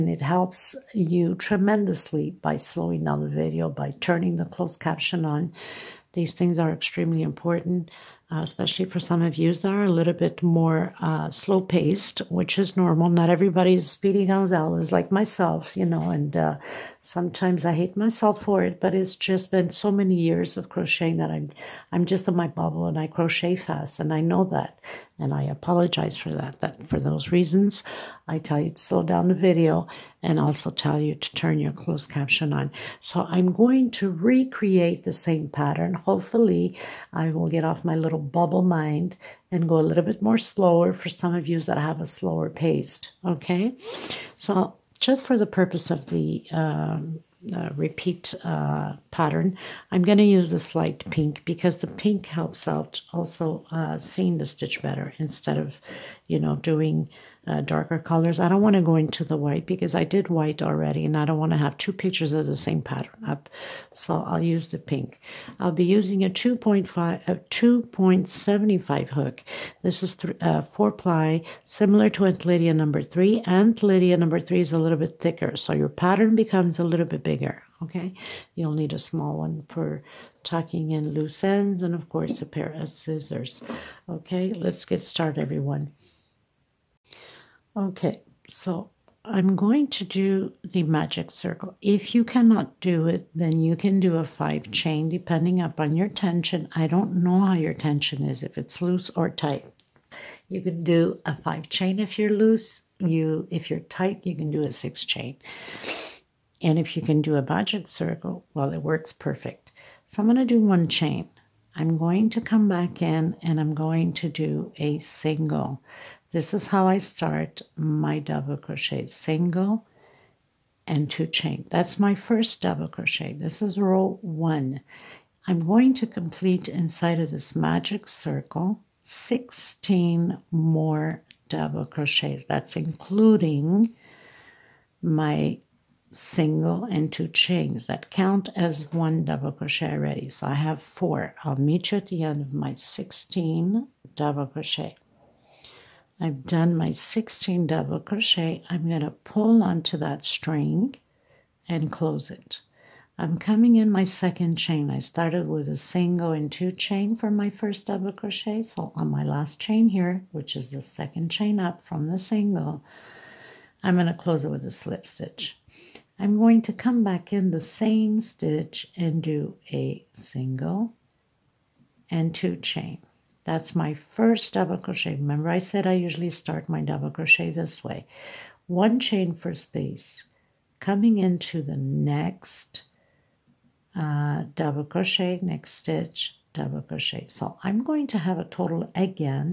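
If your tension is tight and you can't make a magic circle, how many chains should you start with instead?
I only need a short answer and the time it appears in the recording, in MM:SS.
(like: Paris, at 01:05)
6, at 01:44.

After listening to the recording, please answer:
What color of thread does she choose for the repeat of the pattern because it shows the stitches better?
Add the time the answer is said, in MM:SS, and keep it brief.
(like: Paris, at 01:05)
light pink, at 00:50.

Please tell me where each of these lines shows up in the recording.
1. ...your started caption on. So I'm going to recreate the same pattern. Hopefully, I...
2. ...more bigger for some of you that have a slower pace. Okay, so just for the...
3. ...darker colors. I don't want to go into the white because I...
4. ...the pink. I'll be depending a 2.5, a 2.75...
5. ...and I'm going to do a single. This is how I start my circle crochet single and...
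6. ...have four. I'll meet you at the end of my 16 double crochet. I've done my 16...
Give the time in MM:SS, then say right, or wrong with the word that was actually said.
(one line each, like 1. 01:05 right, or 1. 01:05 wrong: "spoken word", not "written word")
1. 00:31 wrong: "closed", not "started"
2. 00:40 wrong: "slower", not "bigger"
3. 00:57 right
4. 01:04 wrong: "using", not "depending"
5. 01:53 wrong: "double", not "circle"
6. 02:20 right.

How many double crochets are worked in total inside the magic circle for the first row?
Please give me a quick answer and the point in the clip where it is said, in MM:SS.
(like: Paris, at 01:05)
16, at 02:09.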